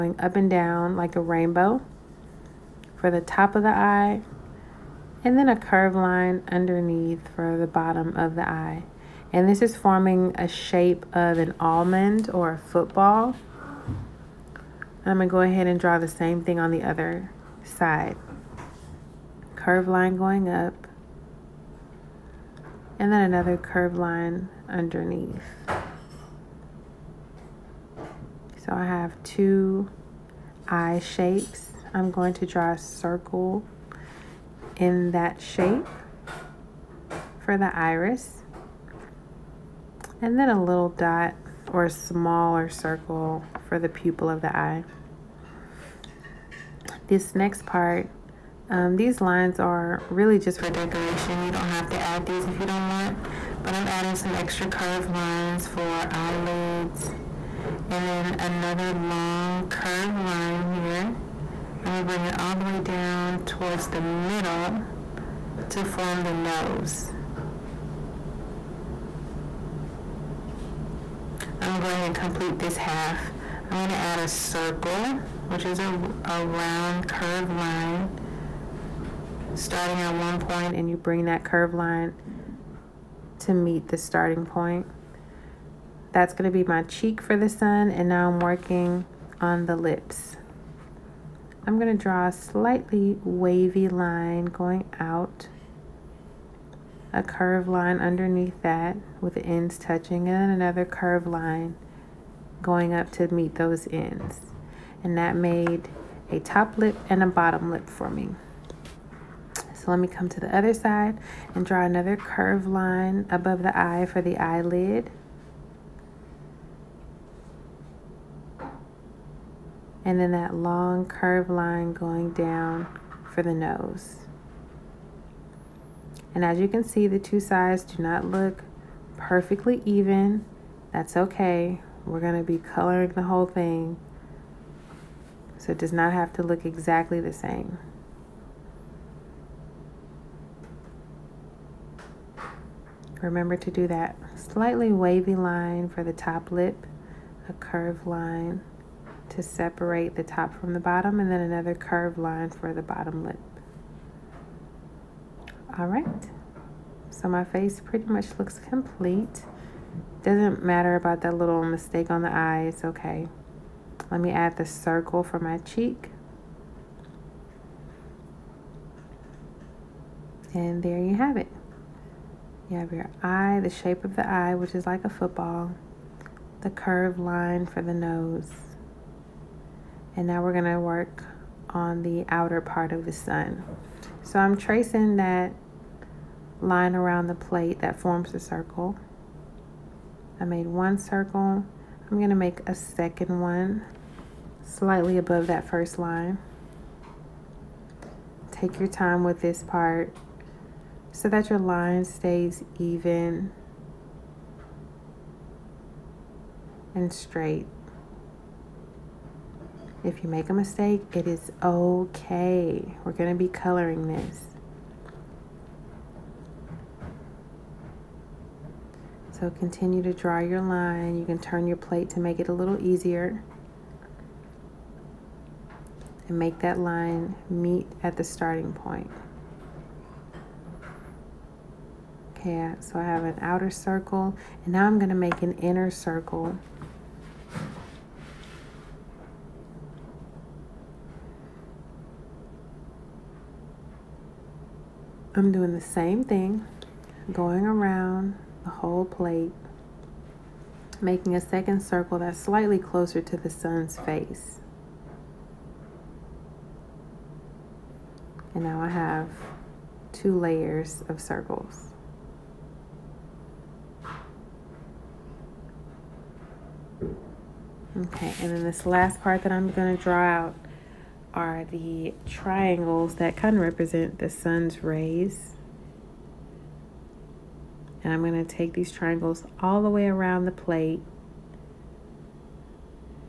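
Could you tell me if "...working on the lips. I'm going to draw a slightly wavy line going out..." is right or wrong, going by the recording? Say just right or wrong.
right.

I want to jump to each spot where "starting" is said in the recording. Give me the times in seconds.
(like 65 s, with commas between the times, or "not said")
79 s, 83 s, 228 s.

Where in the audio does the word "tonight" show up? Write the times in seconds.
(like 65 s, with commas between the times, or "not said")
not said.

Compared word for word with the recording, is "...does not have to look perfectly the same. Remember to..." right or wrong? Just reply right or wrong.
wrong.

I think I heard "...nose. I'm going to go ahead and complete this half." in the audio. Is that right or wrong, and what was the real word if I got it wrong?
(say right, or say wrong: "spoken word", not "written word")
right.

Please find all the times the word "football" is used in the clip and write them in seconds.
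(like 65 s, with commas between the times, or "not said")
12 s, 175 s.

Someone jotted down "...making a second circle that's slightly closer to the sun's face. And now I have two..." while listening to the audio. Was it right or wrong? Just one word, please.
right.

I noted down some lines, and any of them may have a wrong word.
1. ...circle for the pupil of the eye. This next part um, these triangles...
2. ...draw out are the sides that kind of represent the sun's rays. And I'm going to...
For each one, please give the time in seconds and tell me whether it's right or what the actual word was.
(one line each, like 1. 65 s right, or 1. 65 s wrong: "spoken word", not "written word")
1. 42 s wrong: "lines", not "triangles"
2. 270 s wrong: "triangles", not "sides".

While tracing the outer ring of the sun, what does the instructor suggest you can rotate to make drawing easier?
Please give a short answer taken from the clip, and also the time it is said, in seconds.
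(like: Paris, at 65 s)
your plate, at 221 s.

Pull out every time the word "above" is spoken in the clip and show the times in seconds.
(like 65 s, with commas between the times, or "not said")
113 s, 195 s.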